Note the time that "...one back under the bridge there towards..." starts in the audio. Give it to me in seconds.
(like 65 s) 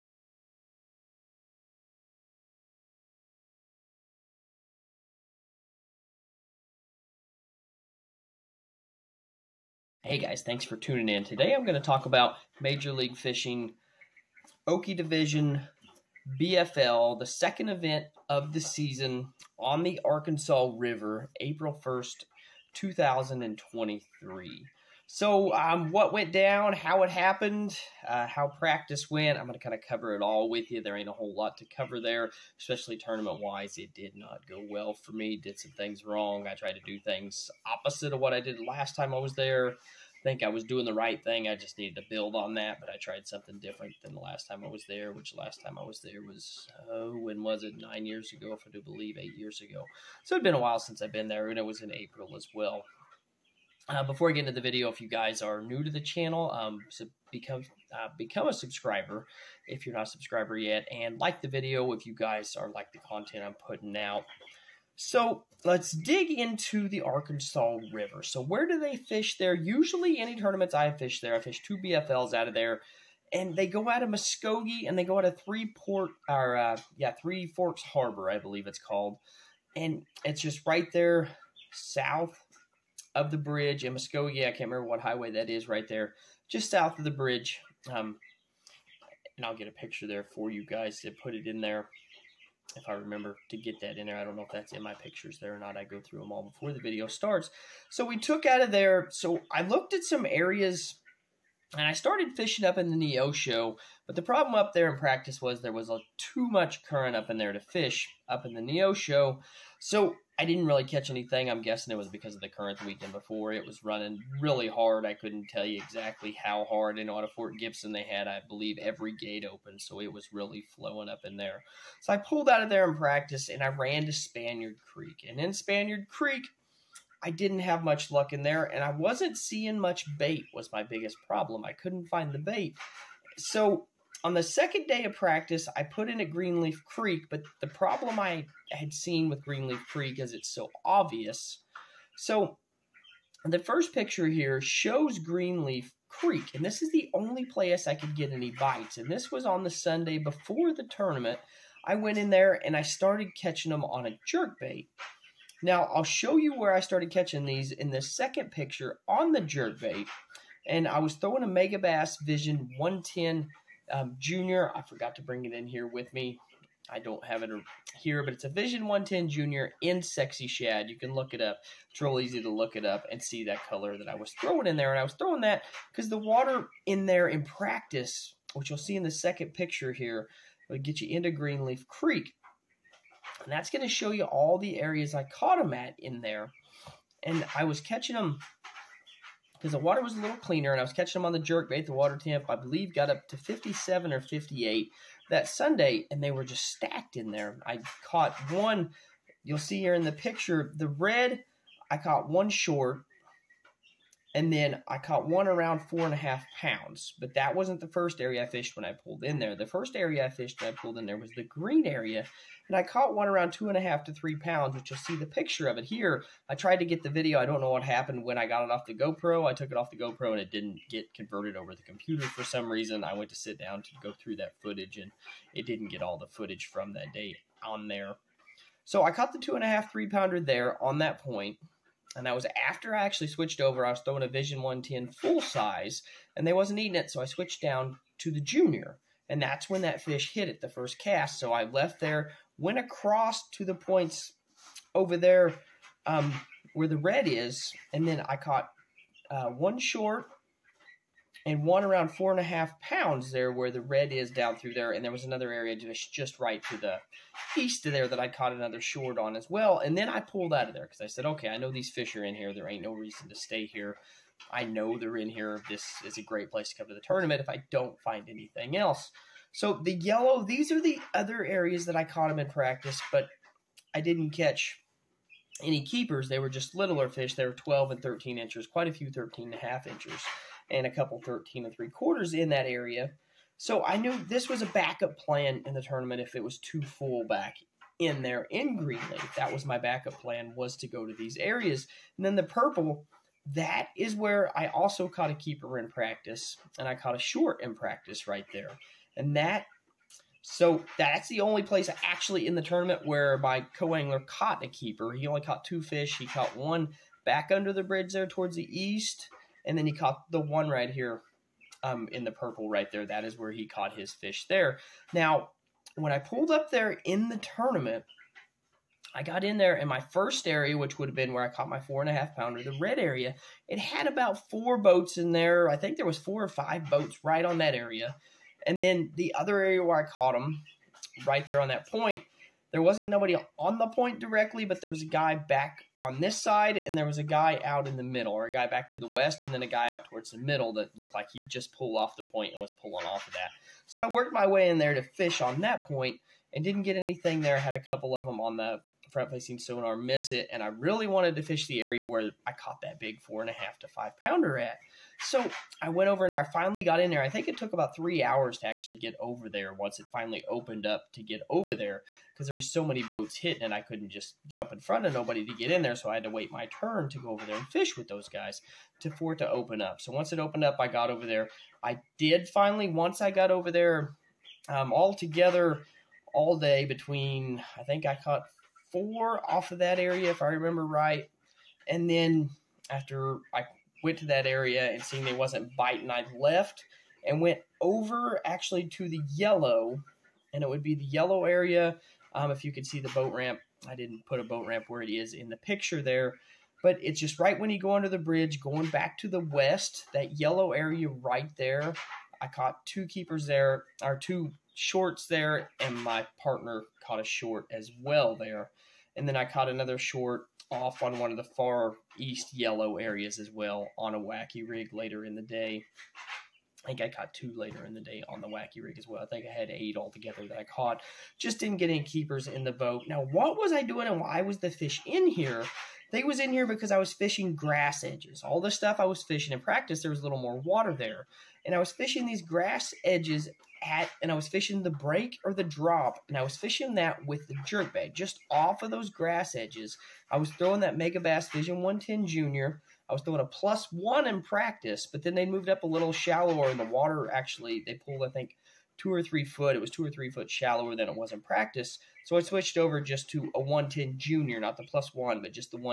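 306 s.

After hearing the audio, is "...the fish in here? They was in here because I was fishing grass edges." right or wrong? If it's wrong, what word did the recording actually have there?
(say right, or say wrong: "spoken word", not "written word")
right.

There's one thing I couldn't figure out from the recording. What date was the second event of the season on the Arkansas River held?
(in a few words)
April 1st, 2023.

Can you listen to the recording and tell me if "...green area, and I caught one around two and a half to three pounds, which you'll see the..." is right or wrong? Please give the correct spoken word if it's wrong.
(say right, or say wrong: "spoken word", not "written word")
right.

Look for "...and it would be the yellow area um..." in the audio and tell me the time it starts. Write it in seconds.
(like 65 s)
390 s.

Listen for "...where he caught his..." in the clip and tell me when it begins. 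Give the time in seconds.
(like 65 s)
313 s.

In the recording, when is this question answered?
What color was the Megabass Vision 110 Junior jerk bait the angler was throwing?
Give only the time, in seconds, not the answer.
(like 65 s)
170 s.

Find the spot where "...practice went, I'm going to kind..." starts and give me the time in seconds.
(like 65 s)
28 s.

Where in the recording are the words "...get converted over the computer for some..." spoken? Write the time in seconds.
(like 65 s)
220 s.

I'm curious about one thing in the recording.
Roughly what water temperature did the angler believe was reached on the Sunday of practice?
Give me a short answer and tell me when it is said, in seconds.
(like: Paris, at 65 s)
57 or 58, at 193 s.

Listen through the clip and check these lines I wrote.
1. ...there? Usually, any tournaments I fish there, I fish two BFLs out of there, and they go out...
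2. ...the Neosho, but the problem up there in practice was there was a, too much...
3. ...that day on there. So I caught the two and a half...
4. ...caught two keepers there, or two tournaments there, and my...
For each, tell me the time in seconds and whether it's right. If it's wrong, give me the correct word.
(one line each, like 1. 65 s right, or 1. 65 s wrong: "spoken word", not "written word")
1. 69 s right
2. 102 s right
3. 226 s right
4. 402 s wrong: "shorts", not "tournaments".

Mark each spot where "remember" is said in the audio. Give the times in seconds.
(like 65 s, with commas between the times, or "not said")
84 s, 92 s, 380 s.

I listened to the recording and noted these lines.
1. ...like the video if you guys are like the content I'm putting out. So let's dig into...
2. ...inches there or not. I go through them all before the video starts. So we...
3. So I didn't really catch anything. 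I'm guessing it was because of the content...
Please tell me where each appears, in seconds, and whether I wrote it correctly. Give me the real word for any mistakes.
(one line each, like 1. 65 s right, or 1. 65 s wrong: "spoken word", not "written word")
1. 61 s right
2. 94 s wrong: "pictures", not "inches"
3. 109 s wrong: "current", not "content".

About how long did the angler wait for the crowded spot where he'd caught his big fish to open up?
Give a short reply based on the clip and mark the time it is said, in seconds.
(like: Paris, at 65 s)
3 hours, at 357 s.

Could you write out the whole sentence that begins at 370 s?
So once it opened up, I got over there.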